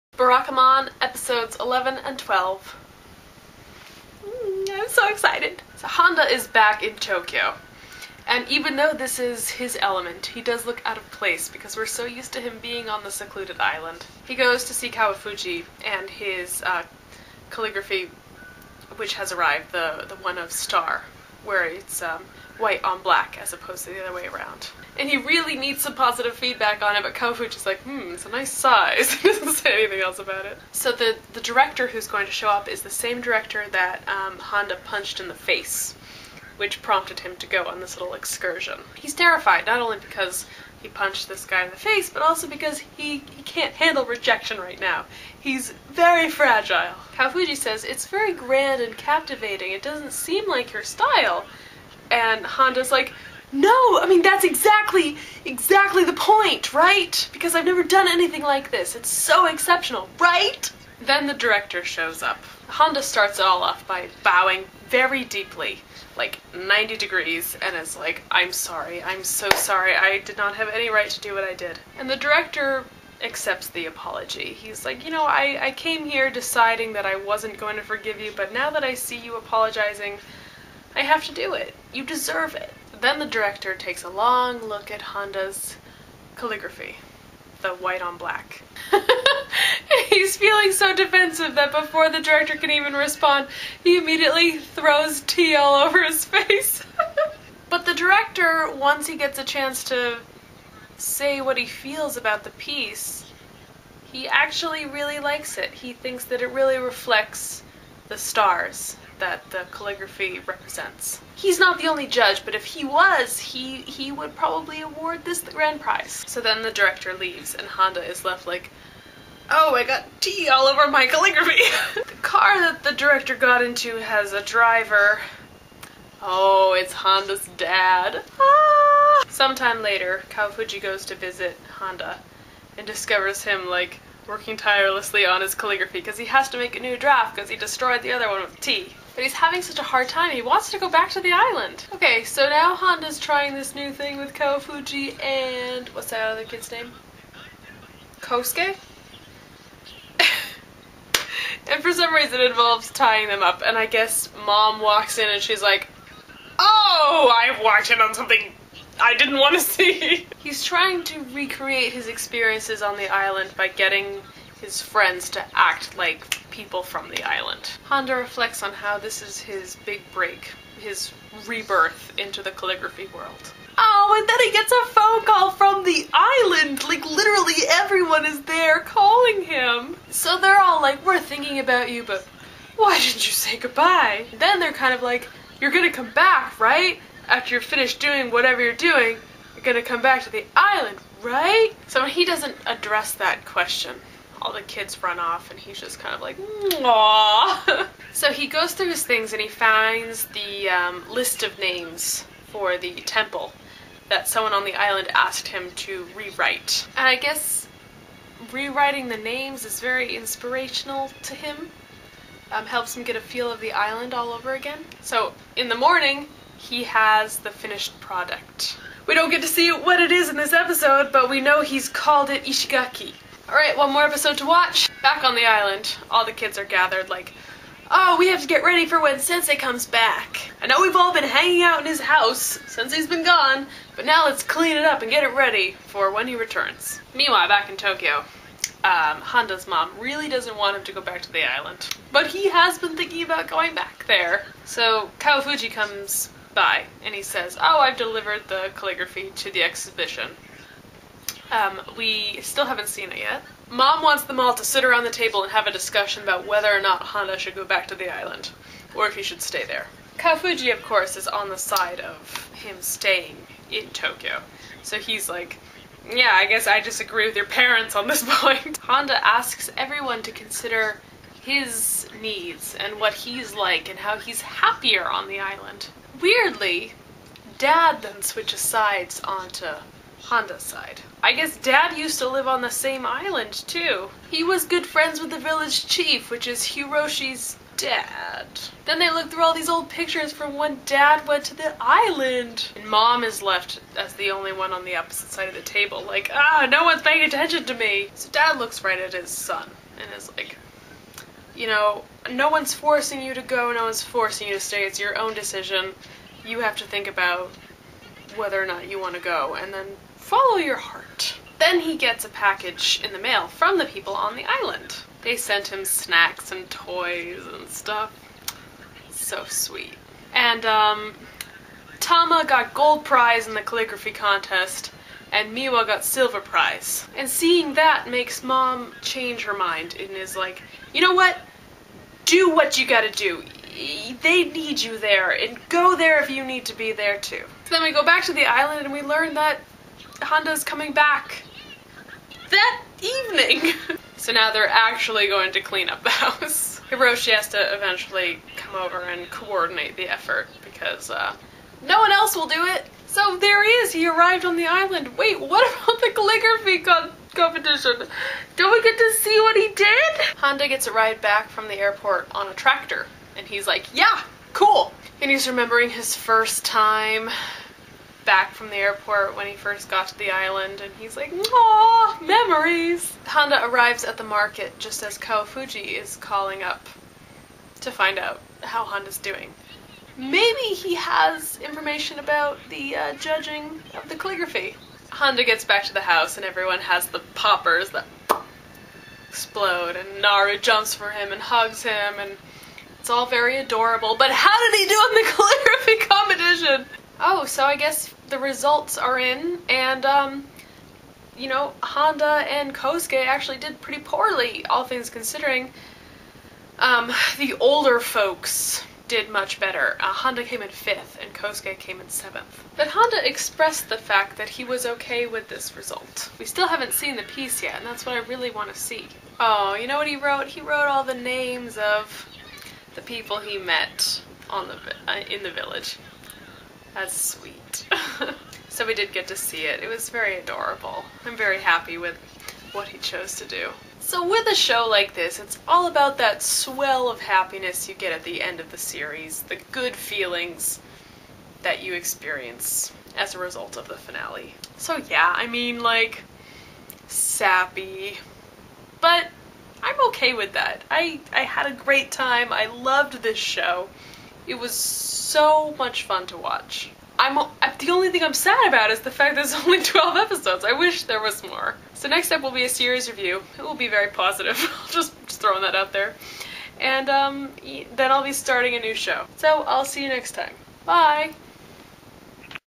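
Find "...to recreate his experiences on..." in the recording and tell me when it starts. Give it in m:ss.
2:41.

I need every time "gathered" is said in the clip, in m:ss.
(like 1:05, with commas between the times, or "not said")
3:46.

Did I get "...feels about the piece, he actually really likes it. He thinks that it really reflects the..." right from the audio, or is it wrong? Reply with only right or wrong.
right.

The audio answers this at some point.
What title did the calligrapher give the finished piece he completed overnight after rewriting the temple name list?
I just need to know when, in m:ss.
3:42.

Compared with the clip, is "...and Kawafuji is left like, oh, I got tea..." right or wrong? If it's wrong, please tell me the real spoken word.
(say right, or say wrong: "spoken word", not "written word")
wrong: "Honda", not "Kawafuji".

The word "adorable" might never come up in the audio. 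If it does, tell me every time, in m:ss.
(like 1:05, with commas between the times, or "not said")
6:33, 7:10.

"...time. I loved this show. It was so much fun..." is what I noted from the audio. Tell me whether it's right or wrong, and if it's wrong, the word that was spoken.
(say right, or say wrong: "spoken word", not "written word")
right.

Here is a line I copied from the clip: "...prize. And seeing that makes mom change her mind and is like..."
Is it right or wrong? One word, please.
right.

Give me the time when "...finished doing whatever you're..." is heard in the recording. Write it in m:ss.
3:07.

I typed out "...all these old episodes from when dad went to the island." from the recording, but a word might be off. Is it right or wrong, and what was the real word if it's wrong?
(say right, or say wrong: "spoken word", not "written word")
wrong: "pictures", not "episodes".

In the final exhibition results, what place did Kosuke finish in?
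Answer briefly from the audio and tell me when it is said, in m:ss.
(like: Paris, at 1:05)
7th, at 6:52.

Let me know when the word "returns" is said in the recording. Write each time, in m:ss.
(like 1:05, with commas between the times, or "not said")
3:56.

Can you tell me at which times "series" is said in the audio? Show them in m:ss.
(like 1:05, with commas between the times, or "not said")
7:18, 7:42.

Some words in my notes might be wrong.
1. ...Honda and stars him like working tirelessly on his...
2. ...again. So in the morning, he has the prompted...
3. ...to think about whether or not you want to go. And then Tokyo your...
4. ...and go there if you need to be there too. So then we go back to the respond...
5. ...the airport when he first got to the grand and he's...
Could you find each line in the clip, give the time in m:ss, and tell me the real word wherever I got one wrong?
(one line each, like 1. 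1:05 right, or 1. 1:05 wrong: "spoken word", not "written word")
1. 2:11 wrong: "discovers", not "stars"
2. 3:34 wrong: "finished", not "prompted"
3. 5:06 wrong: "Follow", not "Tokyo"
4. 5:35 wrong: "island", not "respond"
5. 6:08 wrong: "island", not "grand".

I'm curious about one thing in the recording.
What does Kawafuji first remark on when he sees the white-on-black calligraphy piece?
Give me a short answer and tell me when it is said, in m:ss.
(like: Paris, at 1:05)
Nice size, at 0:28.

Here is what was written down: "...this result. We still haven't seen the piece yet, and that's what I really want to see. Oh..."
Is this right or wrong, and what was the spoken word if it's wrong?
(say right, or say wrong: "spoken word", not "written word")
right.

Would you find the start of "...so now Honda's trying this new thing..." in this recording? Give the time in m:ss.
2:22.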